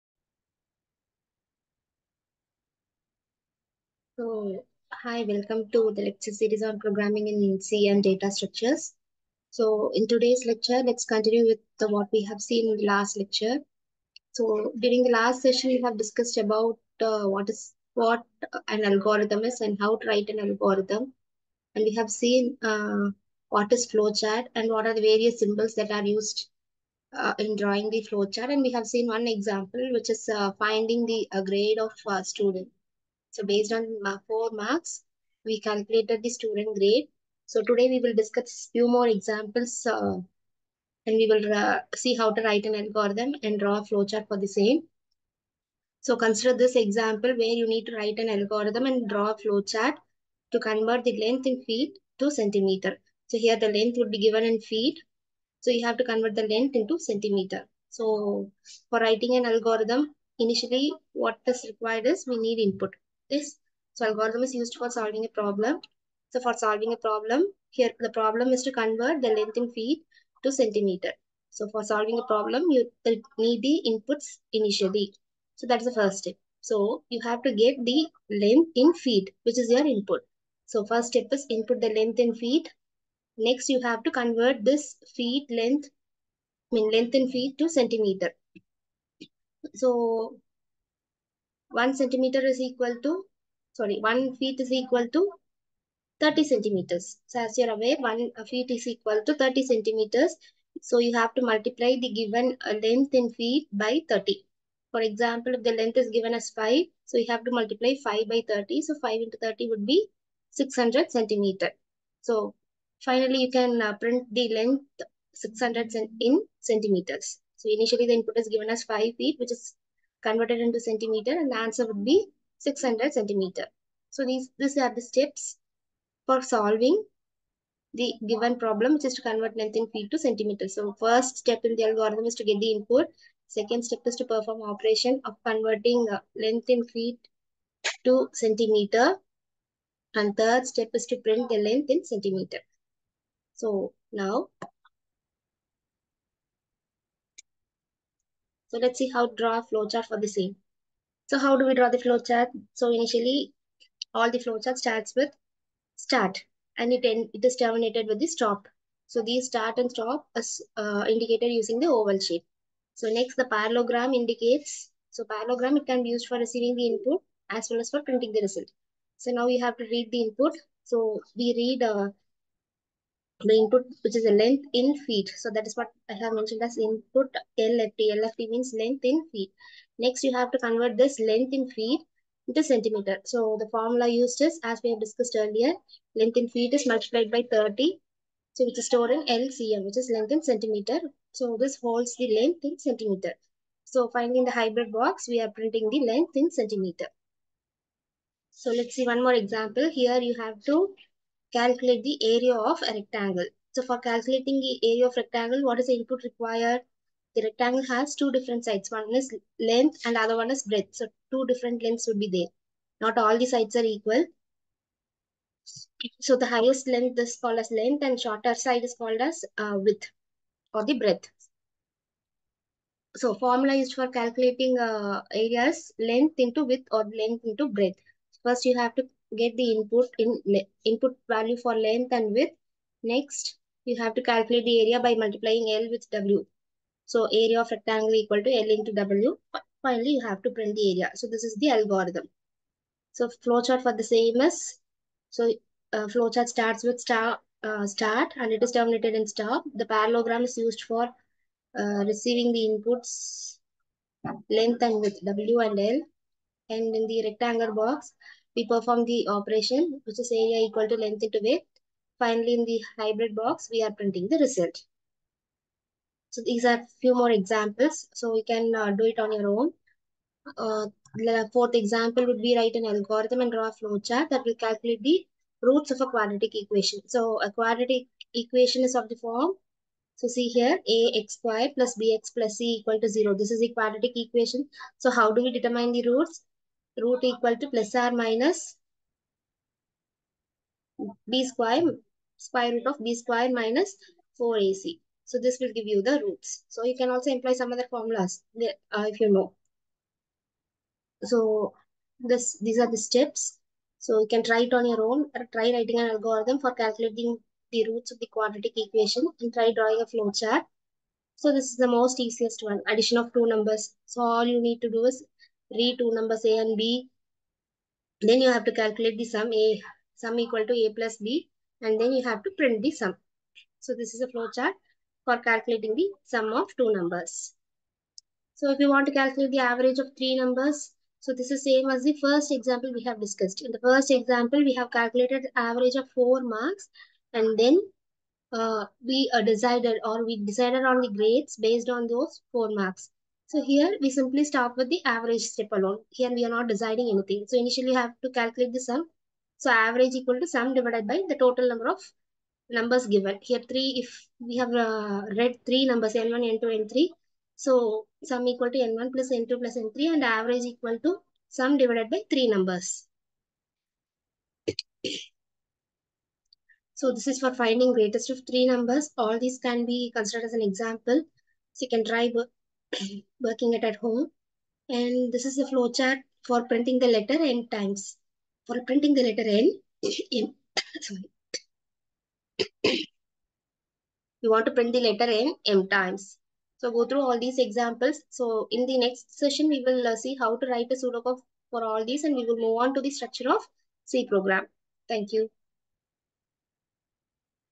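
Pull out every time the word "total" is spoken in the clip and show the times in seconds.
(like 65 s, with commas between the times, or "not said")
351 s.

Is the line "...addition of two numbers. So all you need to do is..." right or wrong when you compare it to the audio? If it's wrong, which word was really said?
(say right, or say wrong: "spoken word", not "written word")
right.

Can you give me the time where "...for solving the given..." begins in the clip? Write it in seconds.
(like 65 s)
126 s.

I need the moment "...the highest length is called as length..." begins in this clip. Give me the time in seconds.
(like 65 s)
216 s.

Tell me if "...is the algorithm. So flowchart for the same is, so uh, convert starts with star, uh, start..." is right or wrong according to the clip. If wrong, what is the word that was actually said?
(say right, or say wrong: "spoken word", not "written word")
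wrong: "flowchart", not "convert".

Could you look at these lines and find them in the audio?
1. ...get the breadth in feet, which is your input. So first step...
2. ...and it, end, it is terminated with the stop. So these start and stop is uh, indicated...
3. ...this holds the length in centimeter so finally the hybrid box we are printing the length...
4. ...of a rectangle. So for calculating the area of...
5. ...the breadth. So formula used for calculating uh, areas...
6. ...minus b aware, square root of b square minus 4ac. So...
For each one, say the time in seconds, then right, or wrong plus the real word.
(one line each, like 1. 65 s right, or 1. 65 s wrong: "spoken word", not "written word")
1. 77 s wrong: "length", not "breadth"
2. 156 s right
3. 191 s right
4. 202 s right
5. 220 s right
6. 288 s wrong: "square", not "aware".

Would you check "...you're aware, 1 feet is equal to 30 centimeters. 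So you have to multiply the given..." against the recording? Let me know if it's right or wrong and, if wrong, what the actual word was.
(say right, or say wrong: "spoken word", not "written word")
right.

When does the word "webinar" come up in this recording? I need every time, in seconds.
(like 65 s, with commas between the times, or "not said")
not said.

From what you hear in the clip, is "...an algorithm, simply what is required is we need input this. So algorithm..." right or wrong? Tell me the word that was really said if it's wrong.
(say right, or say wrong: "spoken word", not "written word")
wrong: "initially", not "simply".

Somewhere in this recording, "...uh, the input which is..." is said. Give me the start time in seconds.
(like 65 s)
171 s.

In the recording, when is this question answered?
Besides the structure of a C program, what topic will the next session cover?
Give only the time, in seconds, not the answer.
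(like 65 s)
390 s.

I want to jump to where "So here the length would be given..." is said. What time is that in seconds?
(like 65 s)
53 s.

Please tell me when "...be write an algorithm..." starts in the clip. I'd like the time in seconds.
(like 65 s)
272 s.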